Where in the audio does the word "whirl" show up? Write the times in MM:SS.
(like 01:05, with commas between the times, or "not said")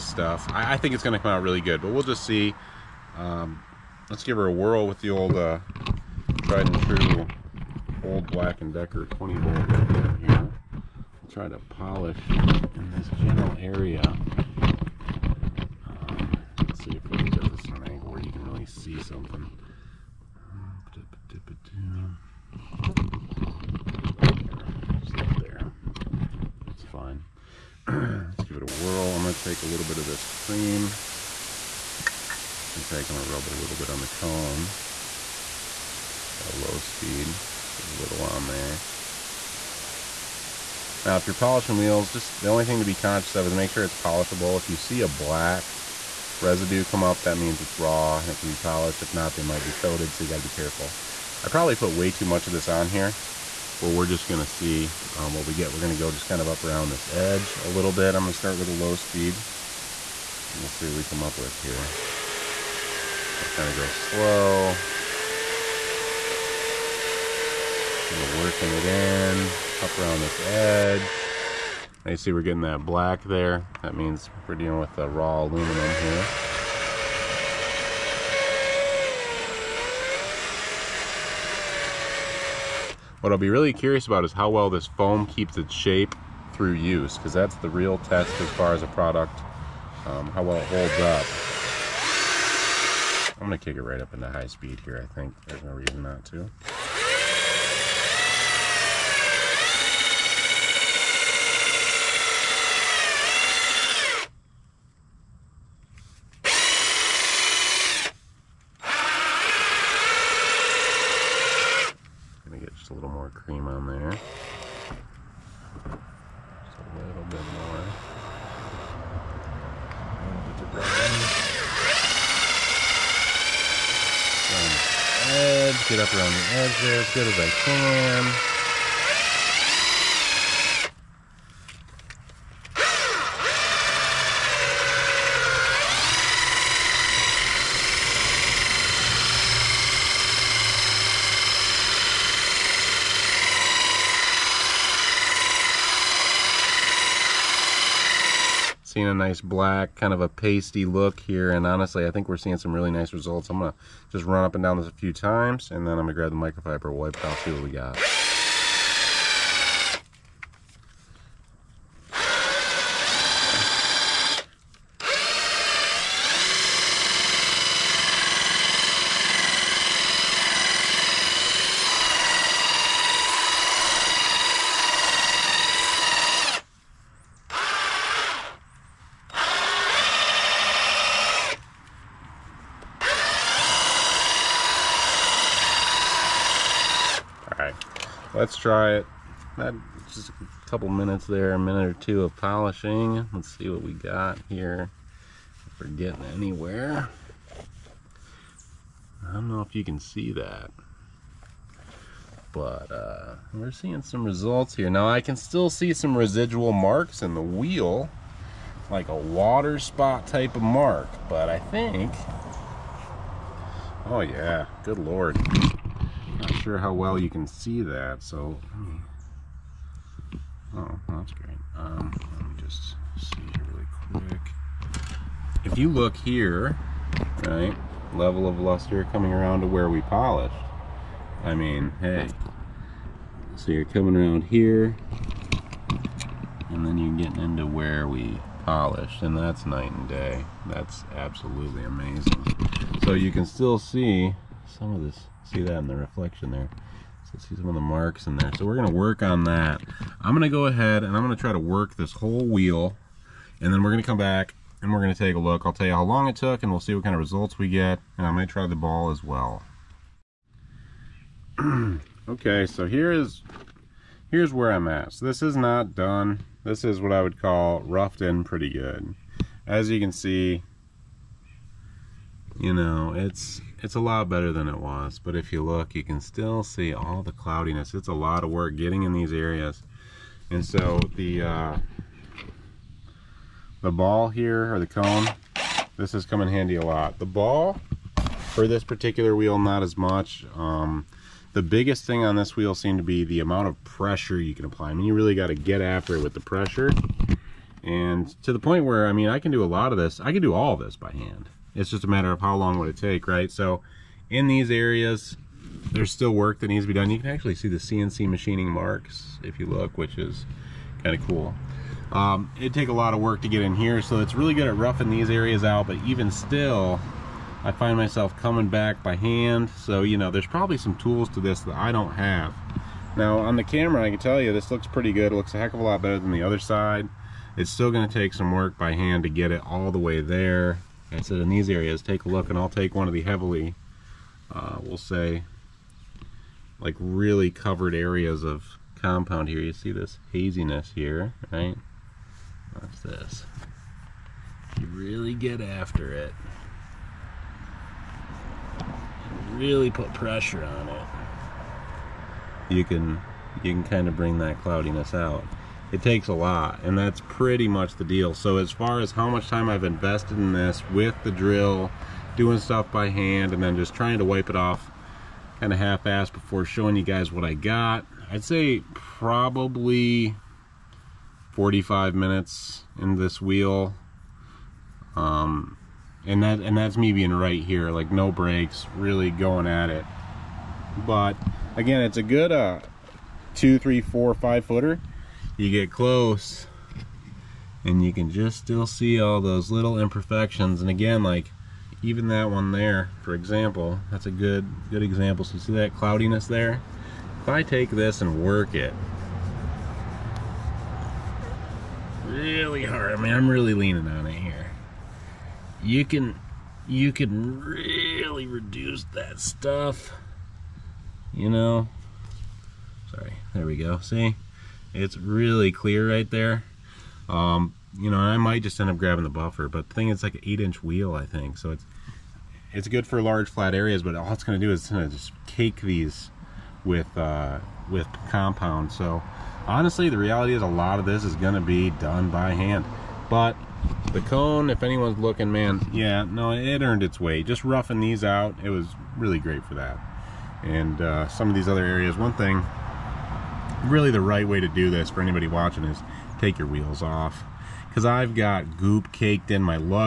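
00:04, 00:28.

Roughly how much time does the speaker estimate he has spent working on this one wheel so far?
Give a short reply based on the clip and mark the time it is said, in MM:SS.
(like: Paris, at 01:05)
45 minutes, at 06:11.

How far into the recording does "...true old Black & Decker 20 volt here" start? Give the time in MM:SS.
00:06.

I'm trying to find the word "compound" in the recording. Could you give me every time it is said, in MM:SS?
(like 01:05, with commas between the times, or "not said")
05:39, 07:08.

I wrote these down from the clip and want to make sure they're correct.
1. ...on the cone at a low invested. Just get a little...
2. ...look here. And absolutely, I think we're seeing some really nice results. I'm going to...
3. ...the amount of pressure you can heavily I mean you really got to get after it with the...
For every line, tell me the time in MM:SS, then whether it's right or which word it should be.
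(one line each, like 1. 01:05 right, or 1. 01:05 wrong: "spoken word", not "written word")
1. 00:33 wrong: "speed", not "invested"
2. 02:30 wrong: "honestly", not "absolutely"
3. 04:53 wrong: "apply", not "heavily".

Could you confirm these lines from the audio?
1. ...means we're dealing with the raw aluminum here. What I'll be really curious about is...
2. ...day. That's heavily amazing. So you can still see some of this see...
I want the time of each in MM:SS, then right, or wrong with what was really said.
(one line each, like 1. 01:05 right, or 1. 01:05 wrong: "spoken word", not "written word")
1. 01:13 right
2. 04:00 wrong: "absolutely", not "heavily".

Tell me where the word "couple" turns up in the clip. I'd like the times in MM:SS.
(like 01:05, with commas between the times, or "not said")
03:10.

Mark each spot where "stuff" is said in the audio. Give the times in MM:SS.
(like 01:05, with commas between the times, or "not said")
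00:00, 06:02, 06:49.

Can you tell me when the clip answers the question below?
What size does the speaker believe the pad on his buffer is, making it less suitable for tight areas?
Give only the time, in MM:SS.
07:00.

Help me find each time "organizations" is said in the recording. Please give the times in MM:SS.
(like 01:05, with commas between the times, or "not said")
not said.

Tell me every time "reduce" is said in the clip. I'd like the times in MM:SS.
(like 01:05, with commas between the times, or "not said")
06:48.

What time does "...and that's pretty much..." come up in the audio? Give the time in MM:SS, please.
05:56.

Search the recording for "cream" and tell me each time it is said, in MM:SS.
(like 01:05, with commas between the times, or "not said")
00:30.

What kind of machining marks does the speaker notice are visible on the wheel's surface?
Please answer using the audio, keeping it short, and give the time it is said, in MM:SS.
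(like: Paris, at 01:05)
CNC machining marks, at 05:07.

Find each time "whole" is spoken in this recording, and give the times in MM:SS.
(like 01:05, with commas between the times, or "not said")
04:12.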